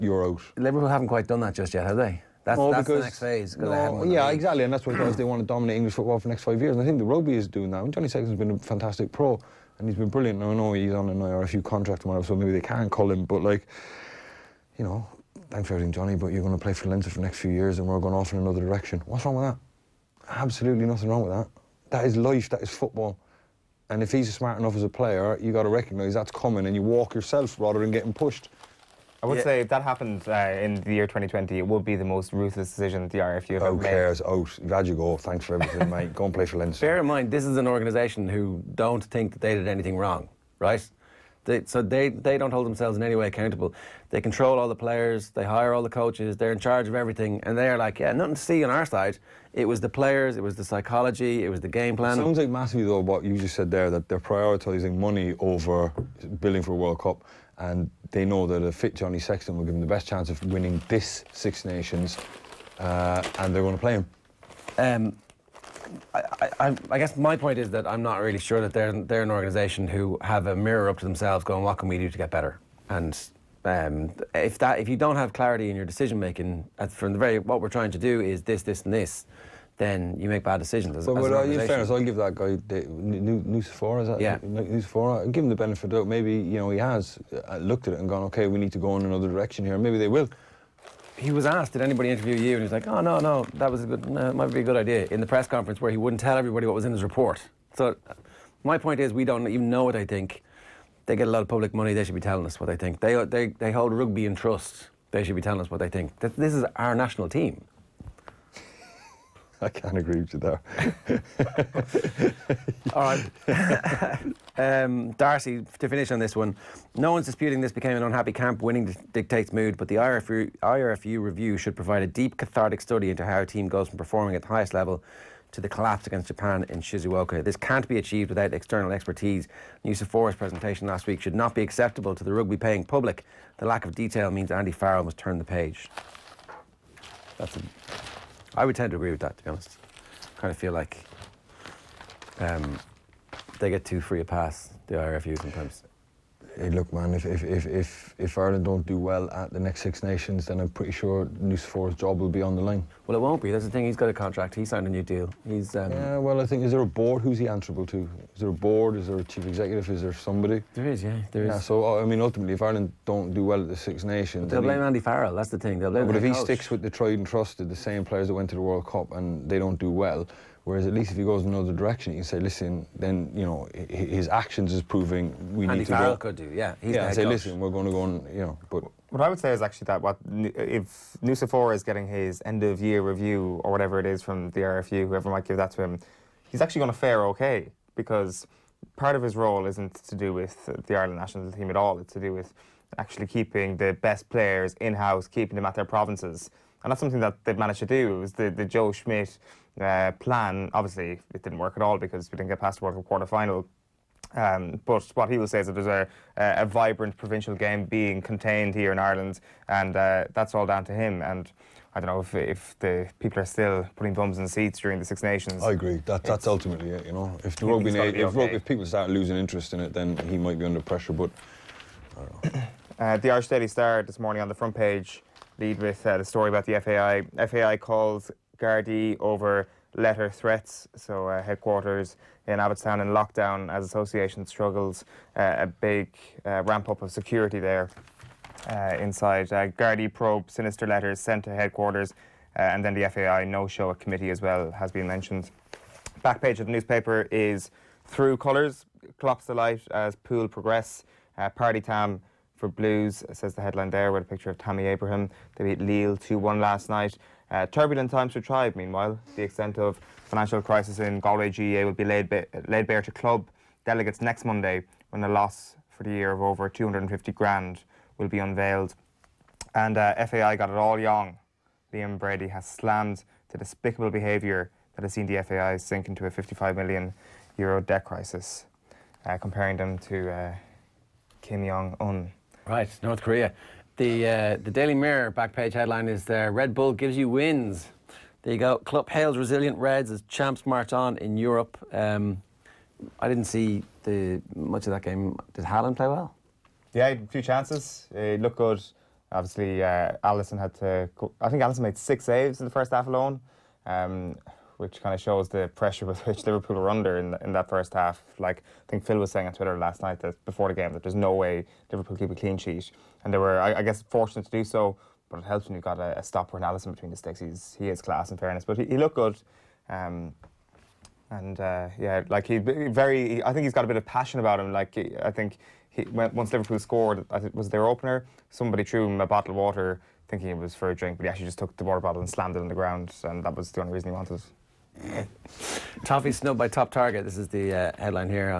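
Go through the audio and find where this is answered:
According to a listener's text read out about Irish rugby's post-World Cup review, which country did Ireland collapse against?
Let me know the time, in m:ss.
2:06.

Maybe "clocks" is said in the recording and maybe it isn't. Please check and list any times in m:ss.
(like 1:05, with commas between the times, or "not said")
4:09.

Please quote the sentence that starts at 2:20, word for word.
I kind of feel like um, they get too free a pass, the IRFU sometimes.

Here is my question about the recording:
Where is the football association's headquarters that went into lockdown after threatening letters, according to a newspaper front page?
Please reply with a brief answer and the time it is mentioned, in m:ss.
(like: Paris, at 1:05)
Abbottstown, at 3:52.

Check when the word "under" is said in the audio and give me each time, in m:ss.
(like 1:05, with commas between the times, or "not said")
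3:40, 5:06.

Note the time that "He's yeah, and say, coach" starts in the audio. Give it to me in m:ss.
2:56.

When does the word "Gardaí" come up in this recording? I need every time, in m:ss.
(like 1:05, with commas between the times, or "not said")
3:48, 3:59.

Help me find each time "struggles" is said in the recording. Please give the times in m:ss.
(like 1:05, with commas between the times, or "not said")
3:54.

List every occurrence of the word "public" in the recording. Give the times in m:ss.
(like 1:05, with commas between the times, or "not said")
1:41, 2:12.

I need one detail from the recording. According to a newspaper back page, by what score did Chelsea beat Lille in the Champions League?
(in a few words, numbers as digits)
2-1.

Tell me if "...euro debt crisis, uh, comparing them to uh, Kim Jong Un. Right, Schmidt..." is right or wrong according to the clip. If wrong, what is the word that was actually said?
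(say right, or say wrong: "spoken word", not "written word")
wrong: "North", not "Schmidt".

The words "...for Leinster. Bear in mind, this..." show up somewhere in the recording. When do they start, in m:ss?
0:36.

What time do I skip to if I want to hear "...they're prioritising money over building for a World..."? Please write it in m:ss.
0:54.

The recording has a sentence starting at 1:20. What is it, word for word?
As, but as well, uh, in fairness, I'll give that guy the, new, Nucifora, is that?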